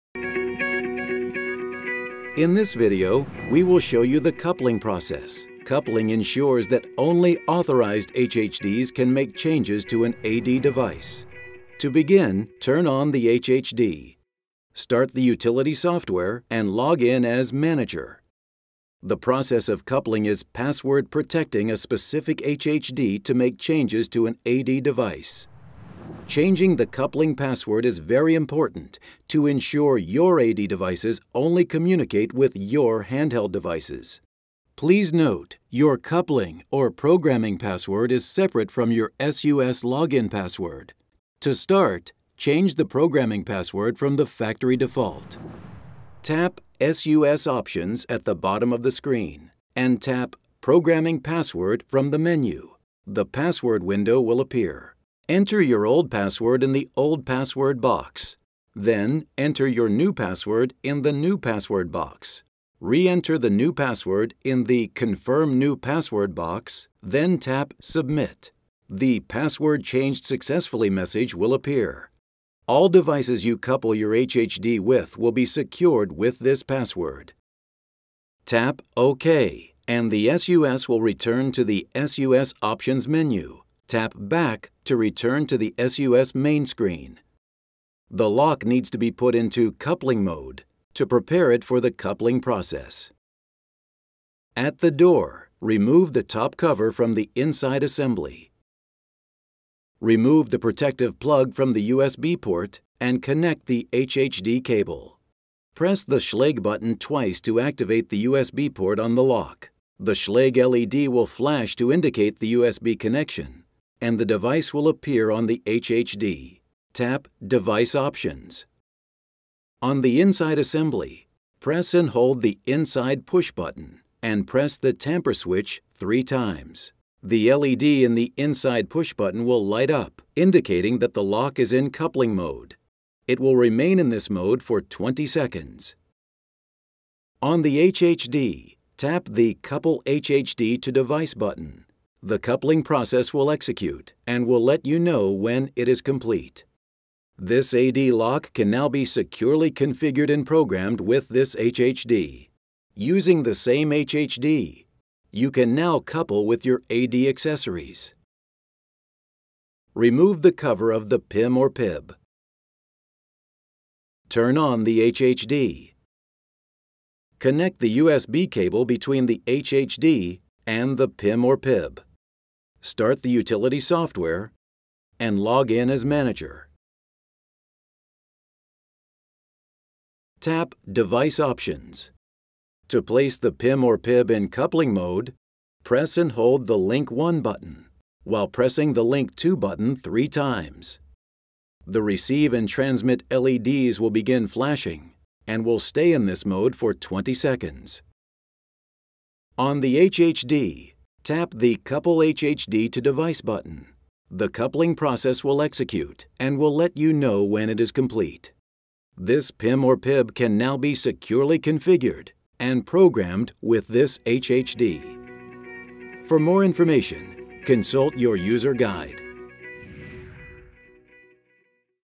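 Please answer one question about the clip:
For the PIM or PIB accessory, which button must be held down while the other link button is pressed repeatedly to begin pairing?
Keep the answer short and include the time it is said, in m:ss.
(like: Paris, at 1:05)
Link 1, at 3:06.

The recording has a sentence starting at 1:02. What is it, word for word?
Re-enter the new password in the Confirm New Password box, then tap Submit.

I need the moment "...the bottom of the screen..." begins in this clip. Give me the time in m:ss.
0:48.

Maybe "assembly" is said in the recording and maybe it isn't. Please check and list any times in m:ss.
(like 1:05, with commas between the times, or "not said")
1:37, 2:00.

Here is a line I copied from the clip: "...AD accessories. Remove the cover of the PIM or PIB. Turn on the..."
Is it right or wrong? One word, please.
right.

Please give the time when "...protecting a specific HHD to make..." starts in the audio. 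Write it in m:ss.
0:21.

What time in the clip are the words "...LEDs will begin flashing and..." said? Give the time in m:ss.
3:13.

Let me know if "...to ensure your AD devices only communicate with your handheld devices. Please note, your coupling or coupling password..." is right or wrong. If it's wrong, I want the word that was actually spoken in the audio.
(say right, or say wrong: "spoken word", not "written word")
wrong: "programming", not "coupling".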